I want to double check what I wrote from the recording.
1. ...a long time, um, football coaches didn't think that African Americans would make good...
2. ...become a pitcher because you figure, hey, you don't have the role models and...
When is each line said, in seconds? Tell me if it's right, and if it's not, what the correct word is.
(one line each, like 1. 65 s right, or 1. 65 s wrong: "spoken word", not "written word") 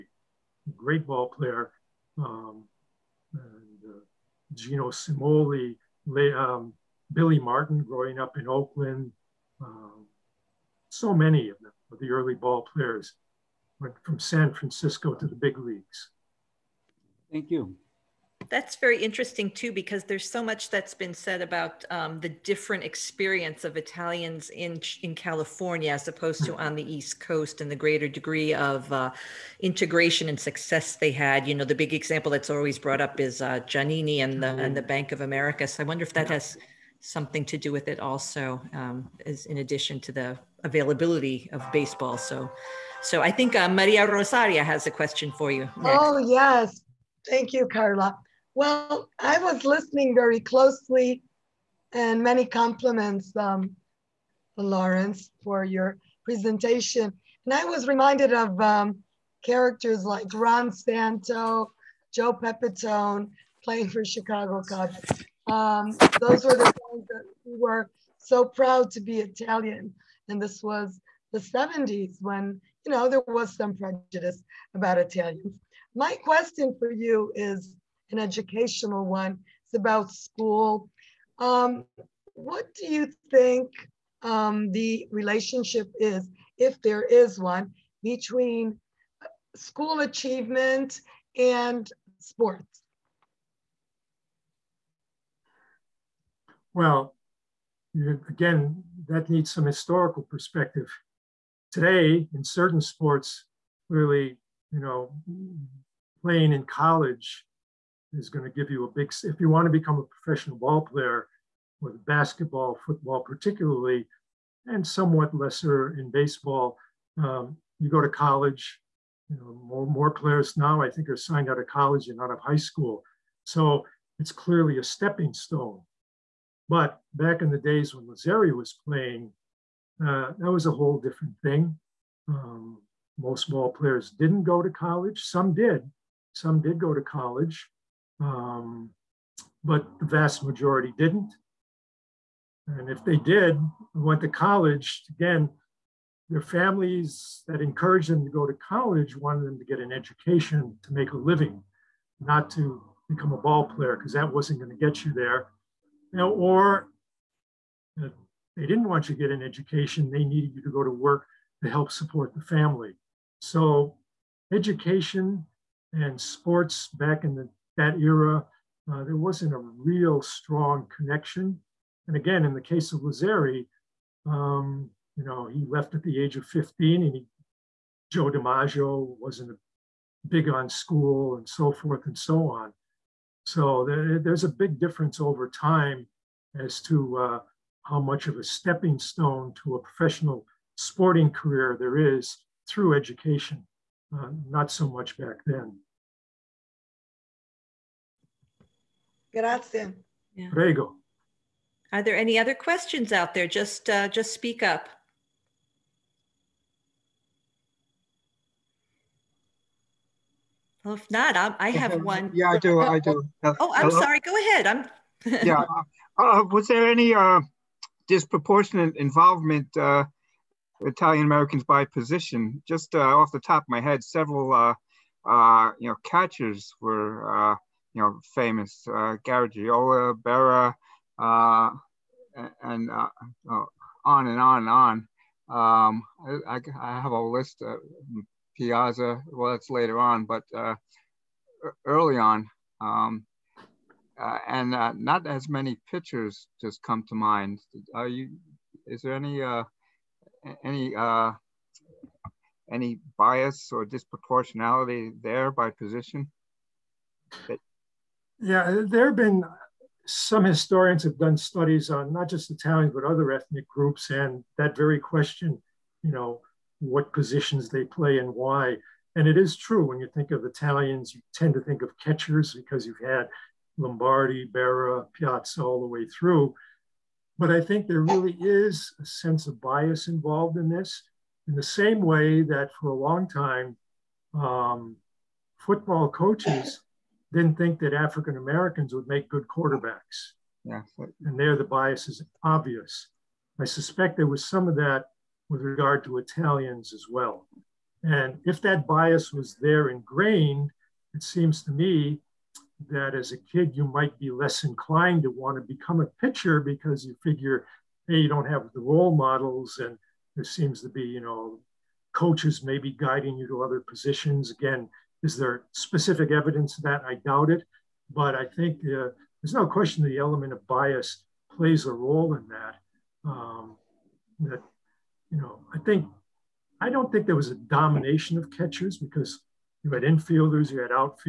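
1. 282 s right
2. 305 s right.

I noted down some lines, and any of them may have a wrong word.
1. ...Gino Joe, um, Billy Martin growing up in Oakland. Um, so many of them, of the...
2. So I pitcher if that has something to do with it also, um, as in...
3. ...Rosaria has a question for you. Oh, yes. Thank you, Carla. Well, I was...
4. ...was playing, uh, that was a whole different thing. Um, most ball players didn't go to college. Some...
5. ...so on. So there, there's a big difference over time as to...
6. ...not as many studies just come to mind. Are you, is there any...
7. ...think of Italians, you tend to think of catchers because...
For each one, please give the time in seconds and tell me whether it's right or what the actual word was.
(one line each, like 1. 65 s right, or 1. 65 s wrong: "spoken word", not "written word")
1. 4 s wrong: "Cimoli", not "Joe"
2. 35 s wrong: "wonder", not "pitcher"
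3. 44 s right
4. 128 s right
5. 182 s right
6. 244 s wrong: "pictures", not "studies"
7. 270 s right.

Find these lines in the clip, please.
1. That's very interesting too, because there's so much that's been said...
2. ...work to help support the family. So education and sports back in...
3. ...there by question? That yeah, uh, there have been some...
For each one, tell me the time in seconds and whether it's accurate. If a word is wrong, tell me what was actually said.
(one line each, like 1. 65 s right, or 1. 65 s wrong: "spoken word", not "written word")
1. 18 s right
2. 160 s right
3. 255 s wrong: "position", not "question".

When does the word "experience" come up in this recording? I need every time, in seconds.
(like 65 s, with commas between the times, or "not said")
22 s.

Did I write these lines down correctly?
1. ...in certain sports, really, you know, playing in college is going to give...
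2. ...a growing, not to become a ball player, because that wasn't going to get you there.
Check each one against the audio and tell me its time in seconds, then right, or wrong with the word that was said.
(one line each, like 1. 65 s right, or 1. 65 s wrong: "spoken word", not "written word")
1. 102 s right
2. 151 s wrong: "living", not "growing".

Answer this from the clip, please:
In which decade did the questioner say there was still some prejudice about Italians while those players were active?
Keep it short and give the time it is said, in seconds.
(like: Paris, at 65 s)
the 70s, at 71 s.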